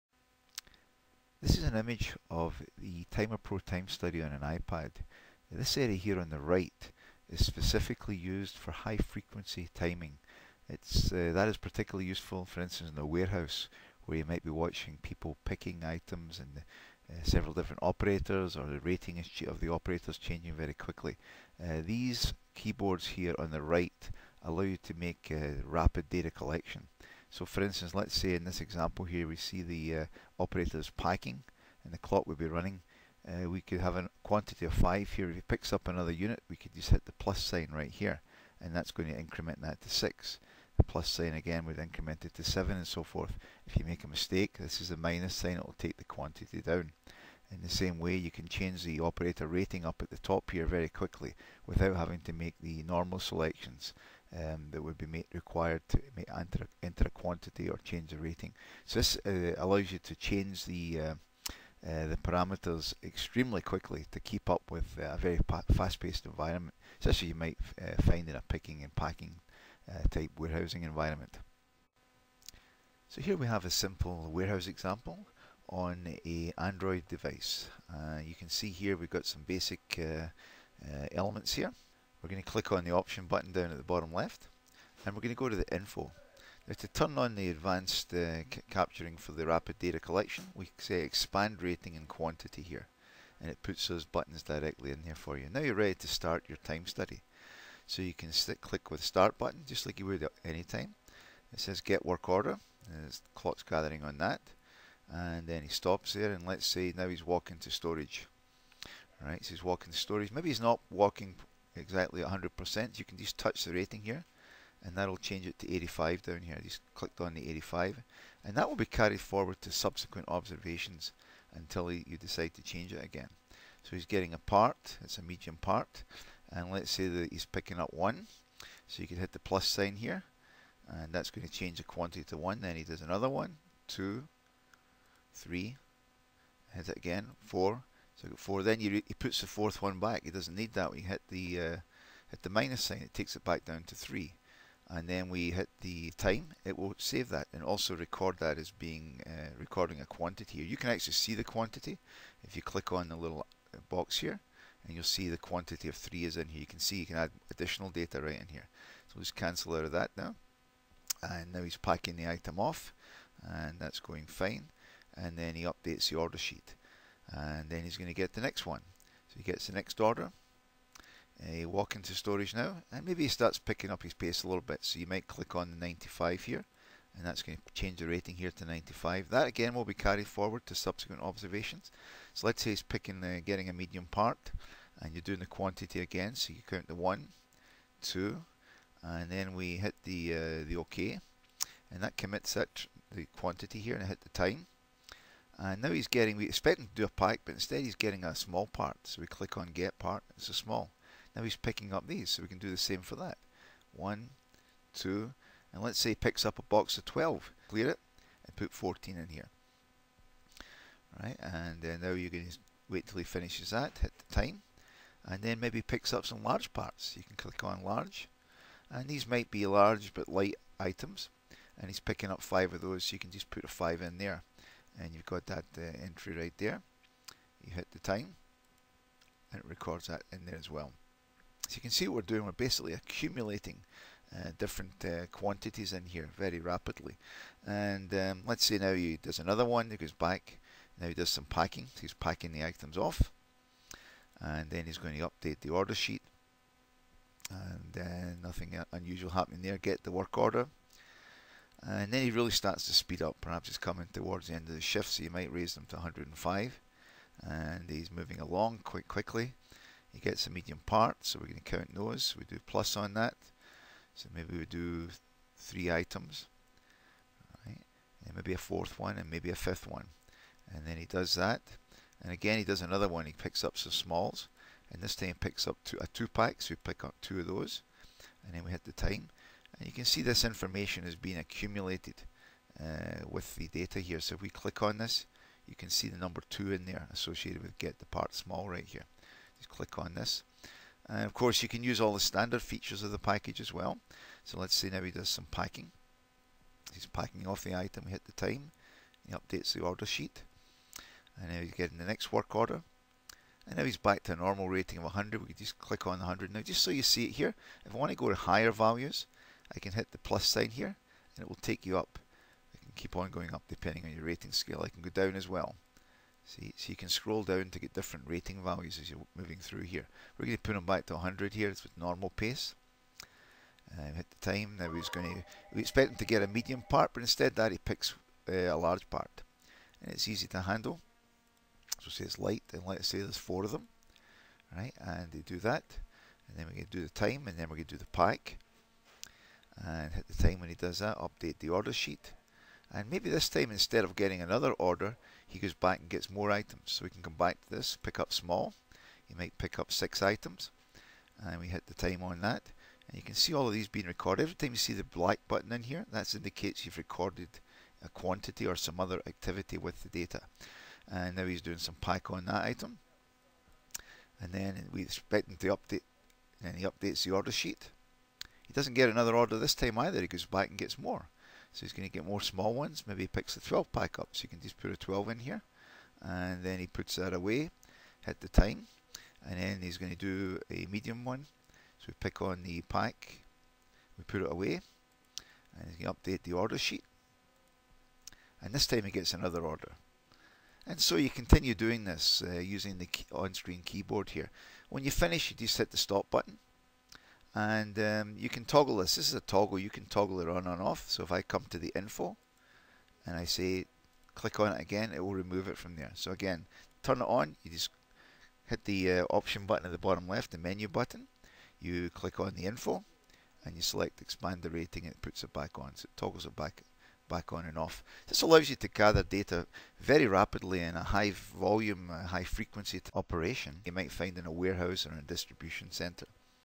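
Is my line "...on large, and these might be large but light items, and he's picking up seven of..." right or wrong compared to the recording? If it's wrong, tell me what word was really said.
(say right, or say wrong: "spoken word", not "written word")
wrong: "five", not "seven".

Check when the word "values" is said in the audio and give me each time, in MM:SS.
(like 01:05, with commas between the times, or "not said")
05:08, 05:18.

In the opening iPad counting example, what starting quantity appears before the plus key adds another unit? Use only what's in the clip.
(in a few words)
5.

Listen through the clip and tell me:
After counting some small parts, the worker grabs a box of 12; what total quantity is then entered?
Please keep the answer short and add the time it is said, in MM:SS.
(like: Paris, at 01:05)
14, at 03:28.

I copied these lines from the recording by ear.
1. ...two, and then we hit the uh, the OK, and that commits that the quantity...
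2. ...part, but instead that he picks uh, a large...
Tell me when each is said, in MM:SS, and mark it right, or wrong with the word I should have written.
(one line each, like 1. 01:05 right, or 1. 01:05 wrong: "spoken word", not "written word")
1. 03:08 right
2. 05:26 right.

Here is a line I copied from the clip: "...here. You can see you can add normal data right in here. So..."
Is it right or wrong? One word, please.
wrong.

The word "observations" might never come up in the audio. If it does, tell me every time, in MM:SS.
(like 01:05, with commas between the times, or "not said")
02:00, 03:01.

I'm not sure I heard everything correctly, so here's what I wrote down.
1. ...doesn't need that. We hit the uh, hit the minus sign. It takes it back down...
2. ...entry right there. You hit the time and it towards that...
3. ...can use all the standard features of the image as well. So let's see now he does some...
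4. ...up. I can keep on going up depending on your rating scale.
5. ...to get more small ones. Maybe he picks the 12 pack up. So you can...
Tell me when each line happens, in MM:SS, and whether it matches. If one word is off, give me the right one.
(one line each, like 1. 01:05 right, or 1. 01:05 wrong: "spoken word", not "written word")
1. 02:20 right
2. 03:46 wrong: "records", not "towards"
3. 04:51 wrong: "package", not "image"
4. 05:11 right
5. 06:12 right.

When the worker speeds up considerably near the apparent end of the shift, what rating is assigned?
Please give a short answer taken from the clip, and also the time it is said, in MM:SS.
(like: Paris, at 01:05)
105, at 04:15.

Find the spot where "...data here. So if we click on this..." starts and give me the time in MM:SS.
04:43.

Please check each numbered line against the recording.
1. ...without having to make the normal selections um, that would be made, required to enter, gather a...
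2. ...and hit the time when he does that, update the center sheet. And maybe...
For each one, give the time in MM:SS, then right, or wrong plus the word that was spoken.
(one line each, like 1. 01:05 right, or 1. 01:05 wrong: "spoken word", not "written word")
1. 00:51 wrong: "enter", not "gather"
2. 05:39 wrong: "order", not "center".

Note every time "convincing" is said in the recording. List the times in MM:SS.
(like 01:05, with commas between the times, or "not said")
not said.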